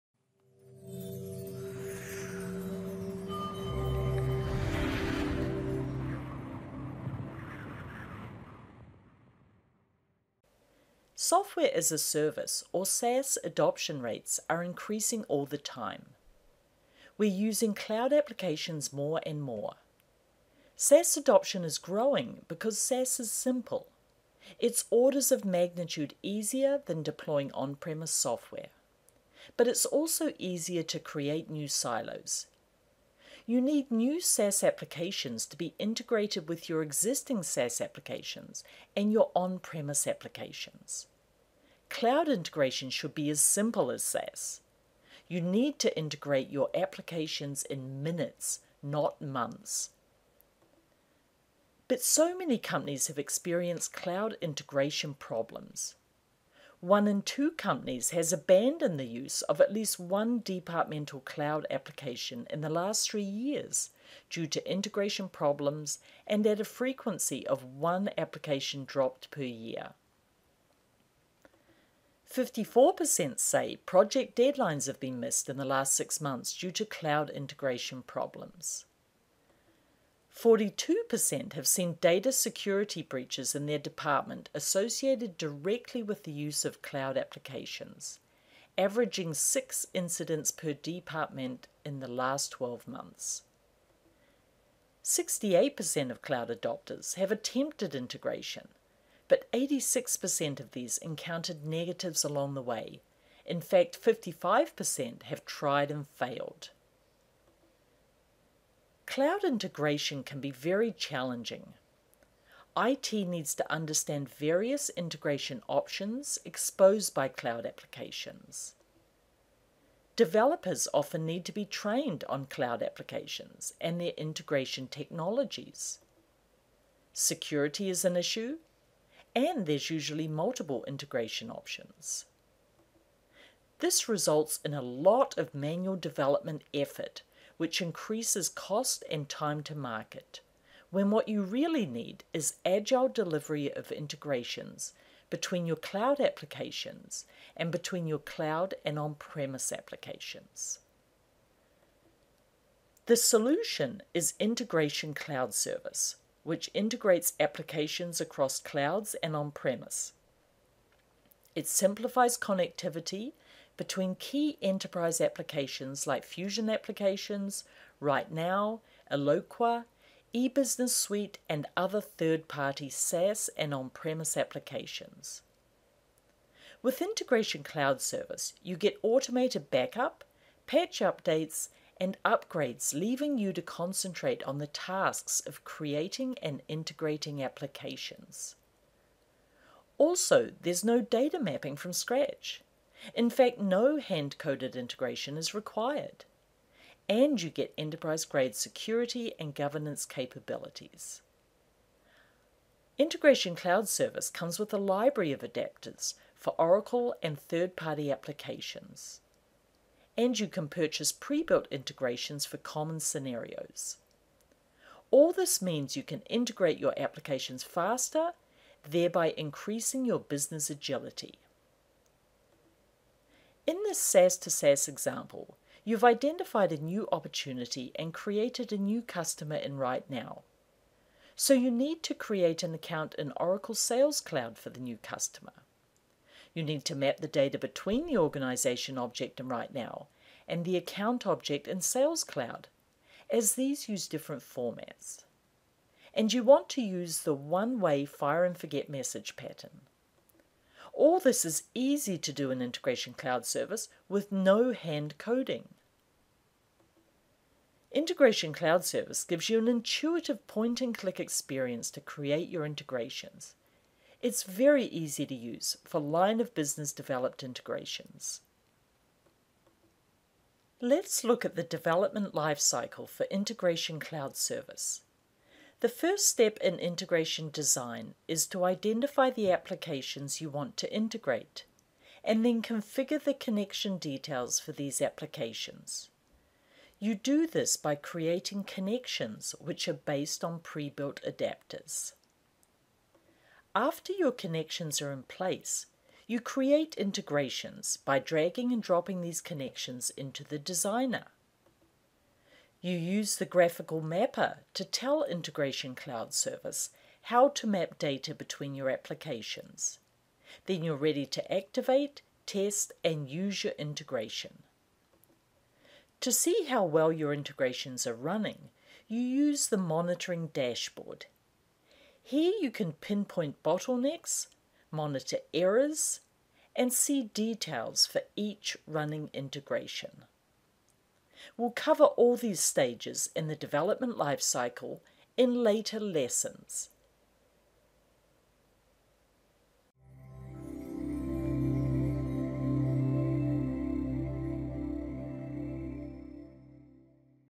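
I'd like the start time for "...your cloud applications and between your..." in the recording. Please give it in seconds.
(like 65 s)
145 s.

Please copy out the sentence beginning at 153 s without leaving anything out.
The solution is Integration Cloud Service, which integrates applications across clouds and on premise.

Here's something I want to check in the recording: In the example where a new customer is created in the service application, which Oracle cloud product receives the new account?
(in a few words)
Oracle Sales Cloud.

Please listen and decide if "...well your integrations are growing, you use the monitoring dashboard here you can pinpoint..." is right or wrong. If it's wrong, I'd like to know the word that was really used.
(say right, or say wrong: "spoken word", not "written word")
wrong: "running", not "growing".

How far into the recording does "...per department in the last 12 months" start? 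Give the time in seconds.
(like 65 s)
90 s.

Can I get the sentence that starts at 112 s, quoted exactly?
IT needs to understand various integration options exposed by cloud applications.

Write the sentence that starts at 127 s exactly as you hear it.
Security is an issue, and there's usually multiple integration options.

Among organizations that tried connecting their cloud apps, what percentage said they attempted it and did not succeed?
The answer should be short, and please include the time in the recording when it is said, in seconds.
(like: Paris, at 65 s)
55%, at 104 s.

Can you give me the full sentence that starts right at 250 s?
All this is easy to do in Integration Cloud Service with no hand coding.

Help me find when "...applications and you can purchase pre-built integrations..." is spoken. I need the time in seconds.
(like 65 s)
208 s.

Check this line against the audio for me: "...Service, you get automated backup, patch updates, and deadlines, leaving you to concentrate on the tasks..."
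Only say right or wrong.
wrong.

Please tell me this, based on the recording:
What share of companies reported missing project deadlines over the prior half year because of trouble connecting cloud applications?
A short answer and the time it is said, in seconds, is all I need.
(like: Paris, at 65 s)
54%, at 72 s.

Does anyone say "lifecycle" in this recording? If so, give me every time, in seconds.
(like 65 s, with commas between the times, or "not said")
272 s, 334 s.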